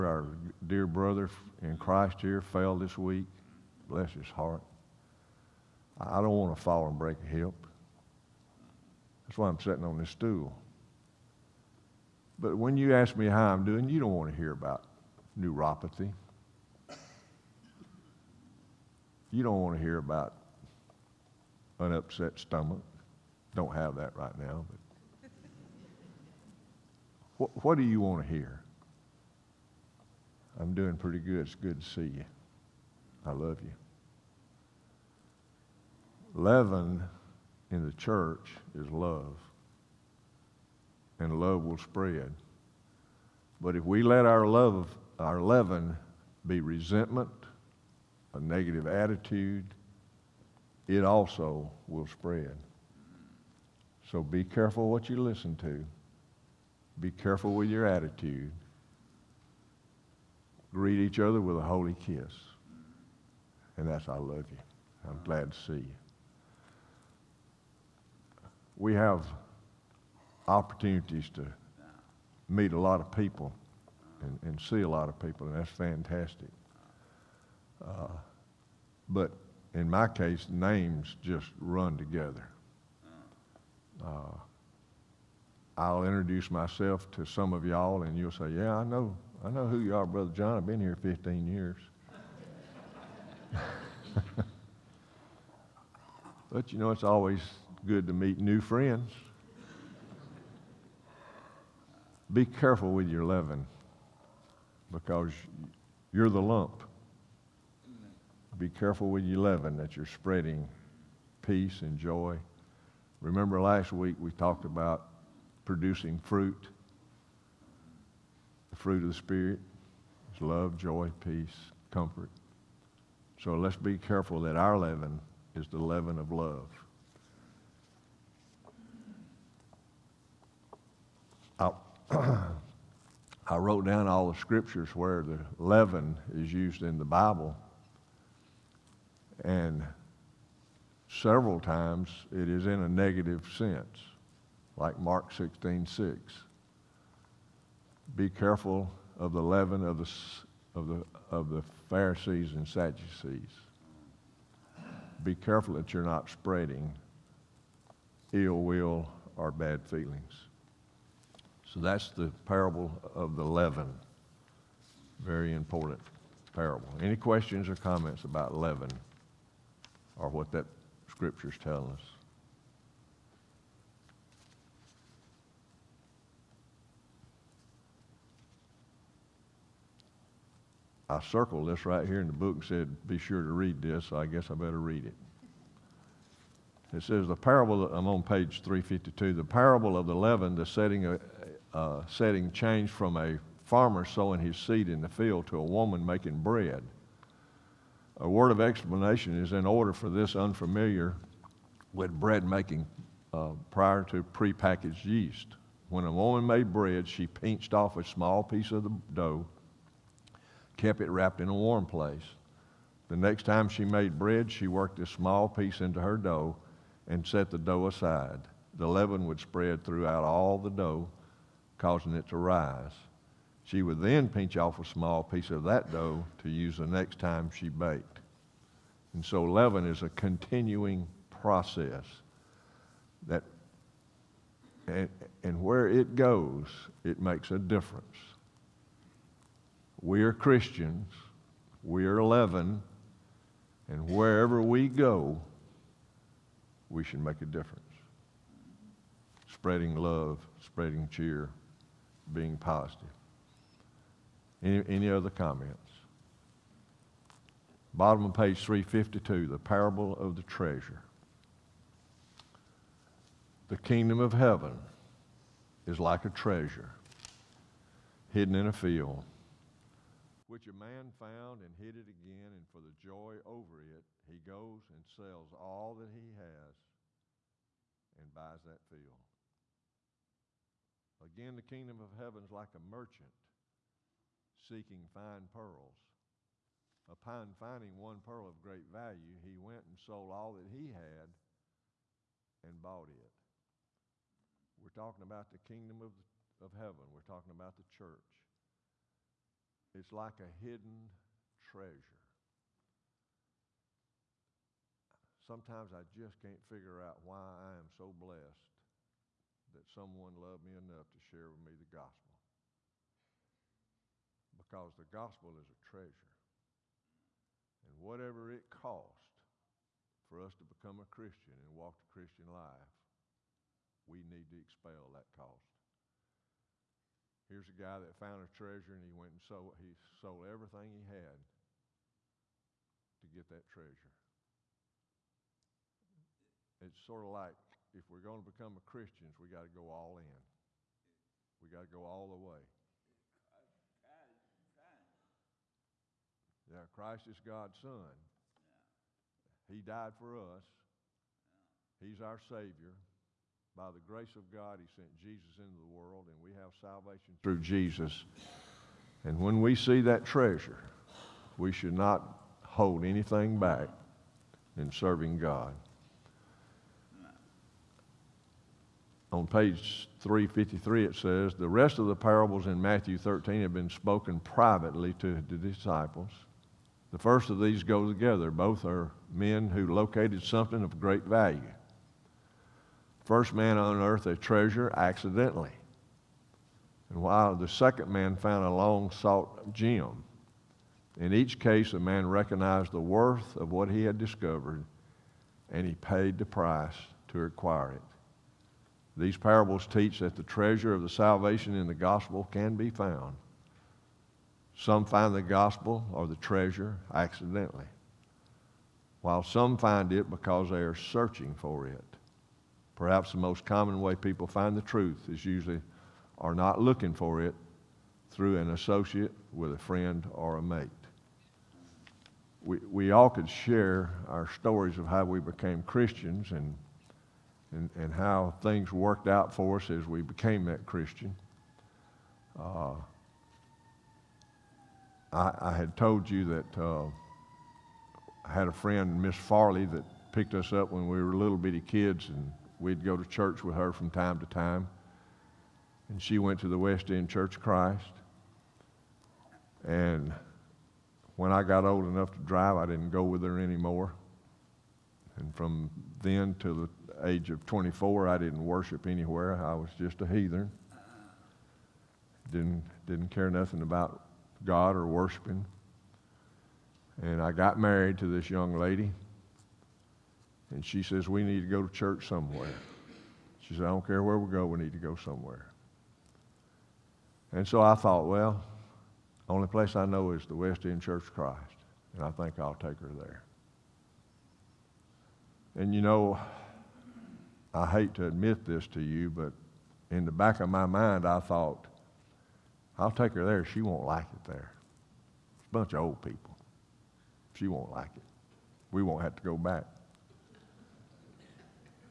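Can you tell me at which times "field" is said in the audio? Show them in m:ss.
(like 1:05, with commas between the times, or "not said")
3:15, 4:28, 4:38.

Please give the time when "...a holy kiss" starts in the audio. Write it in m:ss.
1:01.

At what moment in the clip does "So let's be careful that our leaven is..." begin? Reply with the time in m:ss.
2:03.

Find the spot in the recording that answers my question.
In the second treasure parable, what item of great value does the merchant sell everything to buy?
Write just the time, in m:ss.
4:47.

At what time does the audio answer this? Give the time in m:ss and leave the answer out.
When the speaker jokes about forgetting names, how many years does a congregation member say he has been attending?
1:31.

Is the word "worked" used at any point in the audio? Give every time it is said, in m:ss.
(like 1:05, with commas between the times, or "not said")
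3:34, 7:08.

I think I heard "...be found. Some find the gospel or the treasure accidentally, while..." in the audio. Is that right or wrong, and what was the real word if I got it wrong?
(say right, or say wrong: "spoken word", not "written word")
right.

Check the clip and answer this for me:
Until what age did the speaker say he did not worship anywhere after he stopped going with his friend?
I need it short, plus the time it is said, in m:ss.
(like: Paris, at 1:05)
24, at 7:37.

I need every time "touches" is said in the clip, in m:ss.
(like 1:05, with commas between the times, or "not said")
not said.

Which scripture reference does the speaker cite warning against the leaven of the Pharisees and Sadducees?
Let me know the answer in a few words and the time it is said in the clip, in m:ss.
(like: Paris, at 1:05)
Mark 16 6, at 2:24.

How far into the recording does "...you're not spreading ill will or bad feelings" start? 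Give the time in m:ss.
2:35.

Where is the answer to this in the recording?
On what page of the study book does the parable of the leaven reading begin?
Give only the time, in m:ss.
3:07.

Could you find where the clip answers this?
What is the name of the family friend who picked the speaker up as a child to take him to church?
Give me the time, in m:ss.
7:19.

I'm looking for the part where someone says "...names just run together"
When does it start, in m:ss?
1:20.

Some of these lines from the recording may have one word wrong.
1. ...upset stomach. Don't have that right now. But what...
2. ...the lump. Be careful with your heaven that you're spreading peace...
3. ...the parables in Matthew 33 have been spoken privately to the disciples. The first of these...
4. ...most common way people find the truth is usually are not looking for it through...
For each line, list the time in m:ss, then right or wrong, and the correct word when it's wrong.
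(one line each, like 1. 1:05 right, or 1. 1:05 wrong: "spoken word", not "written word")
1. 0:21 right
2. 1:46 wrong: "leaven", not "heaven"
3. 6:12 wrong: "13", not "33"
4. 6:53 right.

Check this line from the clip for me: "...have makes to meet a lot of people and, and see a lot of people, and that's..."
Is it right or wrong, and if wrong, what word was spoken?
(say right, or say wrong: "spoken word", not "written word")
wrong: "opportunities", not "makes".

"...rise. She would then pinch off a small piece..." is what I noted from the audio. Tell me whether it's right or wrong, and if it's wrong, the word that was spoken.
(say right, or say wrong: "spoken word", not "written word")
right.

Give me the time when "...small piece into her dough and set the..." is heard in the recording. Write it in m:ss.
3:35.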